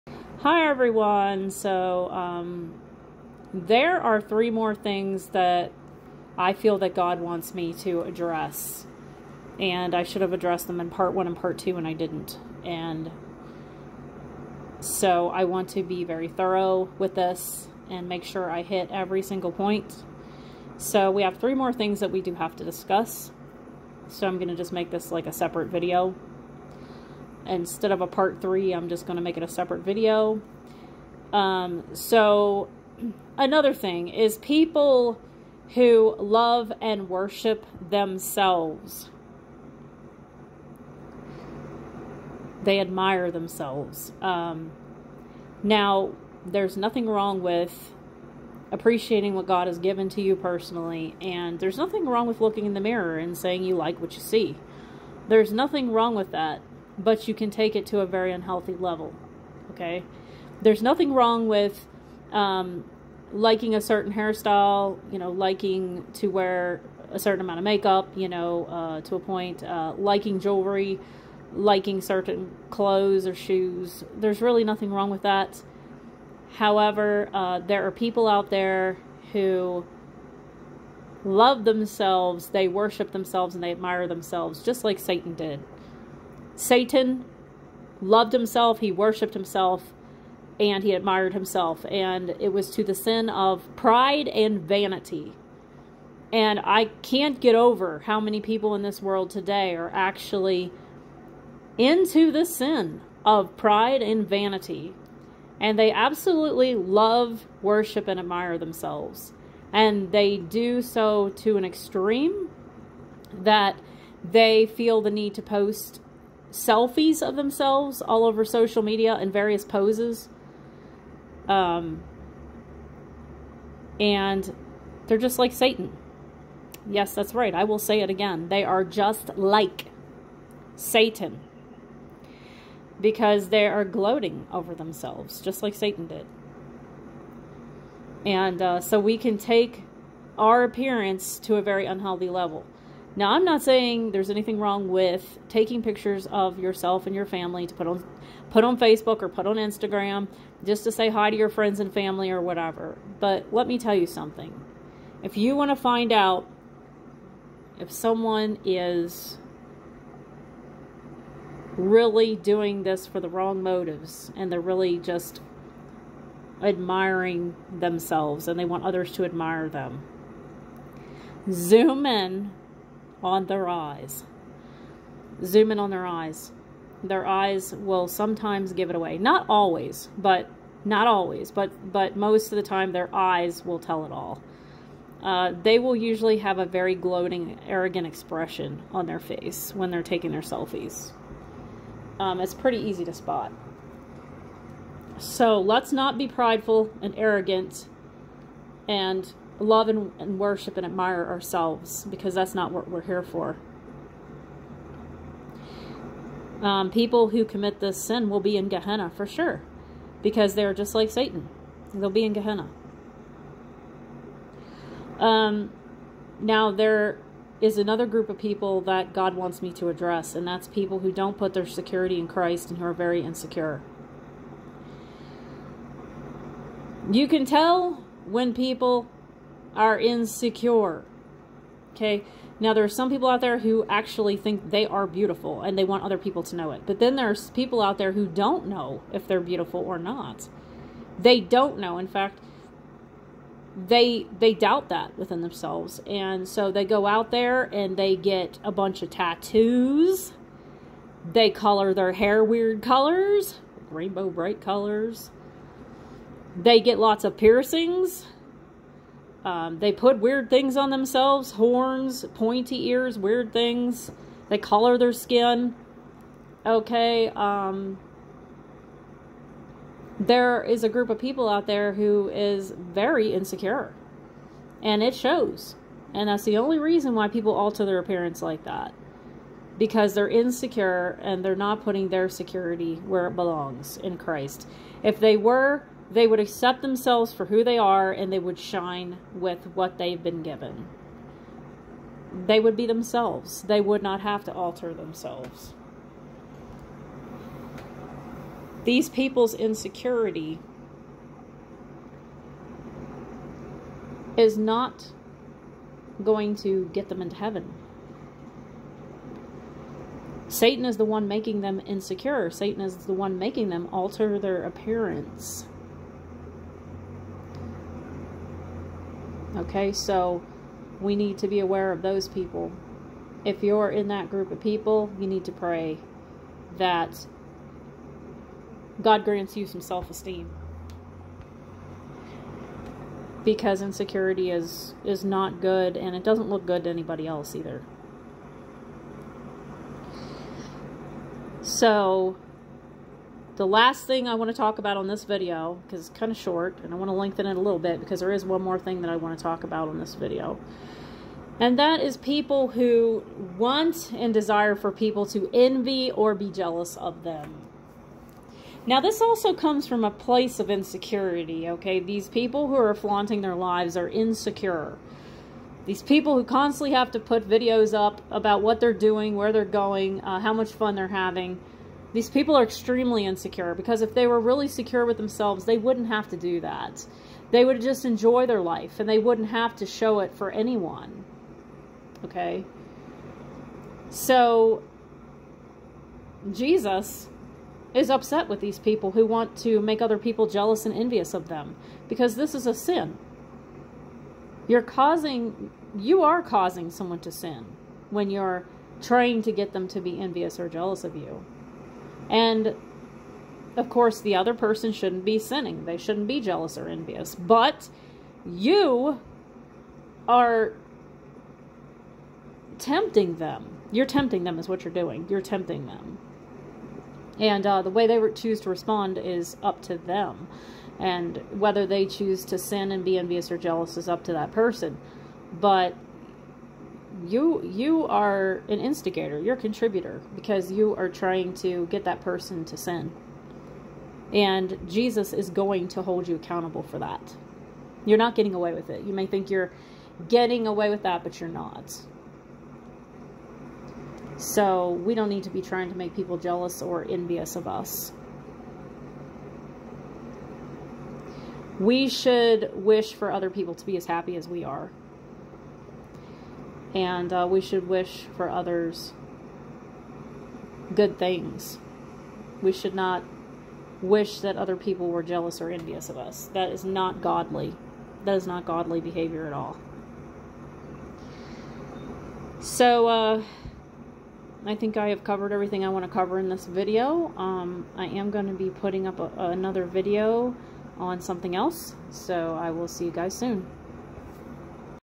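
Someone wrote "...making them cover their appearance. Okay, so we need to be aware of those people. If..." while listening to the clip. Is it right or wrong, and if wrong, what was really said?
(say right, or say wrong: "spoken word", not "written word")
wrong: "alter", not "cover".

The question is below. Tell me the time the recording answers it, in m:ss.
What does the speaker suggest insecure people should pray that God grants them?
5:29.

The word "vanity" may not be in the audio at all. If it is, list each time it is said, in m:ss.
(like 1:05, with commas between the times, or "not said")
1:34, 1:44.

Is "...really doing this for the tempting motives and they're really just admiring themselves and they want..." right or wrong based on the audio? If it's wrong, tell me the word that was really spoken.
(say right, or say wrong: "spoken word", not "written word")
wrong: "wrong", not "tempting".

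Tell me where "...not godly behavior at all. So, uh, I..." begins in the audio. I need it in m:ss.
7:48.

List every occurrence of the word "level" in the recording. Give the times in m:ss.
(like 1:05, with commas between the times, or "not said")
0:58, 2:22.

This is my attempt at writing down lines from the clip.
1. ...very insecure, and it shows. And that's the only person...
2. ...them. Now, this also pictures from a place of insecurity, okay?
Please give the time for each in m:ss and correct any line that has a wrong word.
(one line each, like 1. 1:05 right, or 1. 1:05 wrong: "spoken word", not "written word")
1. 4:32 wrong: "reason", not "person"
2. 5:57 wrong: "comes", not "pictures".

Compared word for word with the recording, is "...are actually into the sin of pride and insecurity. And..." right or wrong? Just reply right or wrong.
wrong.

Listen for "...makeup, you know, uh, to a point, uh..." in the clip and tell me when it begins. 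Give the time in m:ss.
1:07.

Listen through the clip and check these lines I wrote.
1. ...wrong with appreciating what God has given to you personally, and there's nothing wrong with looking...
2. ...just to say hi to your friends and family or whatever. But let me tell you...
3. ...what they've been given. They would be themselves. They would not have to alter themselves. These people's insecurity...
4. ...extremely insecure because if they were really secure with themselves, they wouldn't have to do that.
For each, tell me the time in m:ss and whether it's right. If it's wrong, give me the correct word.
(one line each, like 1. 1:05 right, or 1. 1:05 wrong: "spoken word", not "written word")
1. 0:47 right
2. 2:30 right
3. 4:49 right
4. 6:12 right.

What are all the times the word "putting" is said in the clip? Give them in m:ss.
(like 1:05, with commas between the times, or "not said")
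4:41, 7:58.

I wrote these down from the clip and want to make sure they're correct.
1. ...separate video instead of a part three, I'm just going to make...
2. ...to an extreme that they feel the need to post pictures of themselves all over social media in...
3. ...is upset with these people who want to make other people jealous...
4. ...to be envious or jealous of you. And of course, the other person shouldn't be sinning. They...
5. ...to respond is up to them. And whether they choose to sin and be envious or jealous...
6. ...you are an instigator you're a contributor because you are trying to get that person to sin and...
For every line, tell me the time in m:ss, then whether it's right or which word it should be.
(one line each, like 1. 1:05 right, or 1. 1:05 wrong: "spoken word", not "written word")
1. 0:25 right
2. 1:51 wrong: "selfies", not "pictures"
3. 6:27 right
4. 6:39 right
5. 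6:58 right
6. 7:07 right.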